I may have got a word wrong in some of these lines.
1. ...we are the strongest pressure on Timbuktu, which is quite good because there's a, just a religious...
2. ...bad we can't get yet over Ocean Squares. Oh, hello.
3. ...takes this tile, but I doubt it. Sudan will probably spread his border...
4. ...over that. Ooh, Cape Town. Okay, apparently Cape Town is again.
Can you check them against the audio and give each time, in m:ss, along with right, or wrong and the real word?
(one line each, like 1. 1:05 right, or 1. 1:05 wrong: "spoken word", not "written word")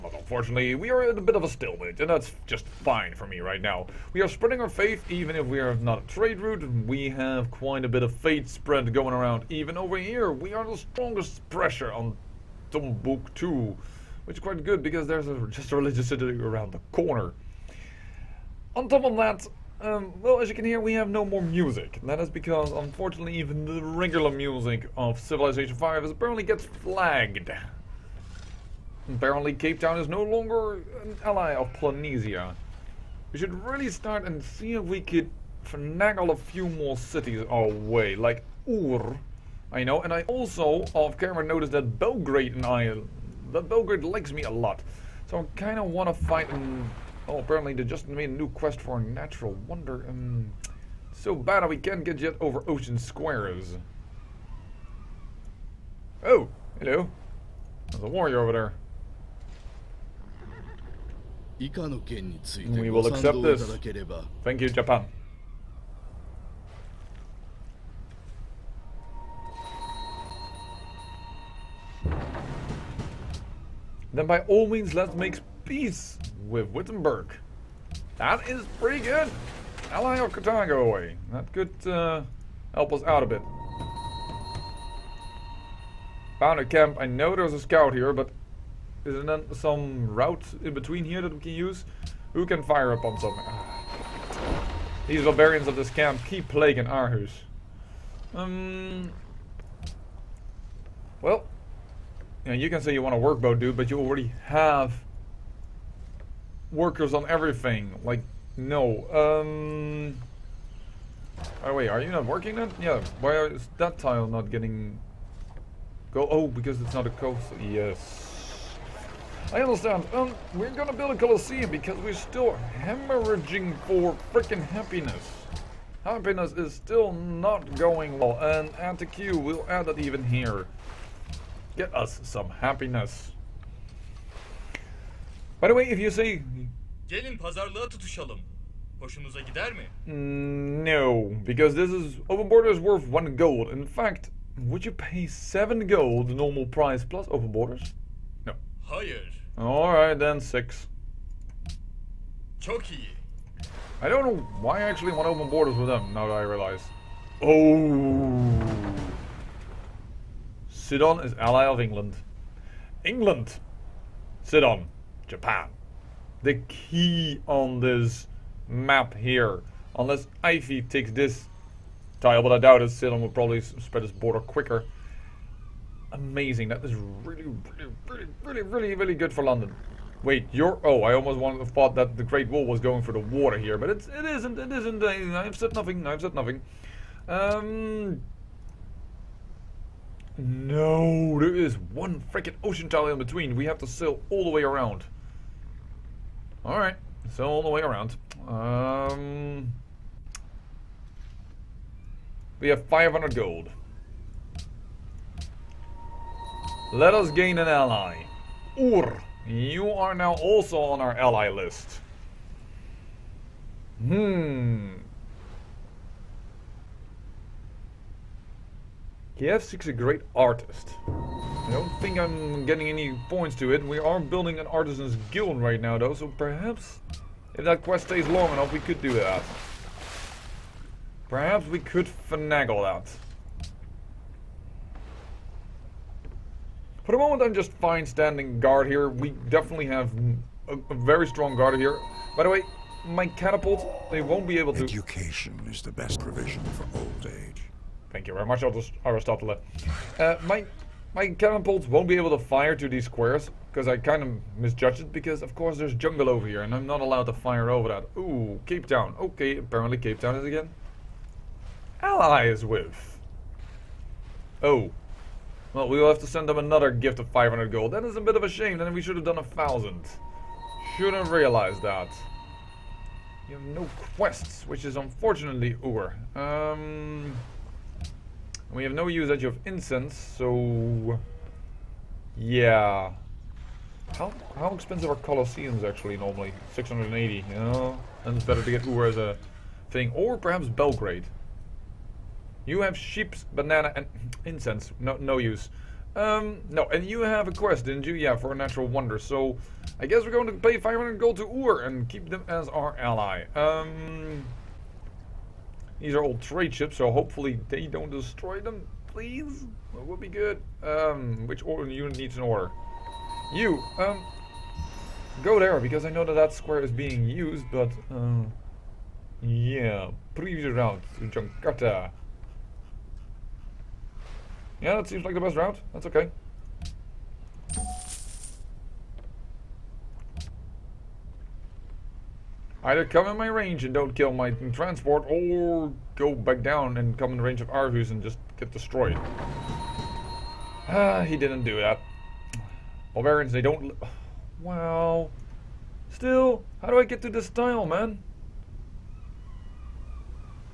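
1. 0:10 right
2. 0:51 right
3. 2:50 right
4. 4:17 right.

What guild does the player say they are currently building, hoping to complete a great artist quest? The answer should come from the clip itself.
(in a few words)
Artisan's guild.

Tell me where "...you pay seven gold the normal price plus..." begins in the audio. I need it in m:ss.
2:24.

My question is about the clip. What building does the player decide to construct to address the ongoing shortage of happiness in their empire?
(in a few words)
Coliseum.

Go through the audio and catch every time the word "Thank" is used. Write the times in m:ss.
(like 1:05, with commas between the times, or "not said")
1:04, 4:08.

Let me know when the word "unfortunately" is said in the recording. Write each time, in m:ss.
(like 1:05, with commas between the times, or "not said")
0:00, 0:22, 4:34.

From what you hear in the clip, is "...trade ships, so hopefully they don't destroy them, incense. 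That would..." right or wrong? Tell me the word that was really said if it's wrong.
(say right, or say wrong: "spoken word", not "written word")
wrong: "please", not "incense".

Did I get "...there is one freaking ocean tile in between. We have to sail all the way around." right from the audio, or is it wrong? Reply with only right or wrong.
right.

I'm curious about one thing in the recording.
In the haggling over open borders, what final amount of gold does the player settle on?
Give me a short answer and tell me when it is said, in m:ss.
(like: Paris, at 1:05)
6, at 2:30.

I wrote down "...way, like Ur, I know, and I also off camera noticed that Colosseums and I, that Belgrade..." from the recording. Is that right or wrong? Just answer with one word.
wrong.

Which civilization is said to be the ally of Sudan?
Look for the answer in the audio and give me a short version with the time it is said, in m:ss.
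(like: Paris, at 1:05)
England, at 2:40.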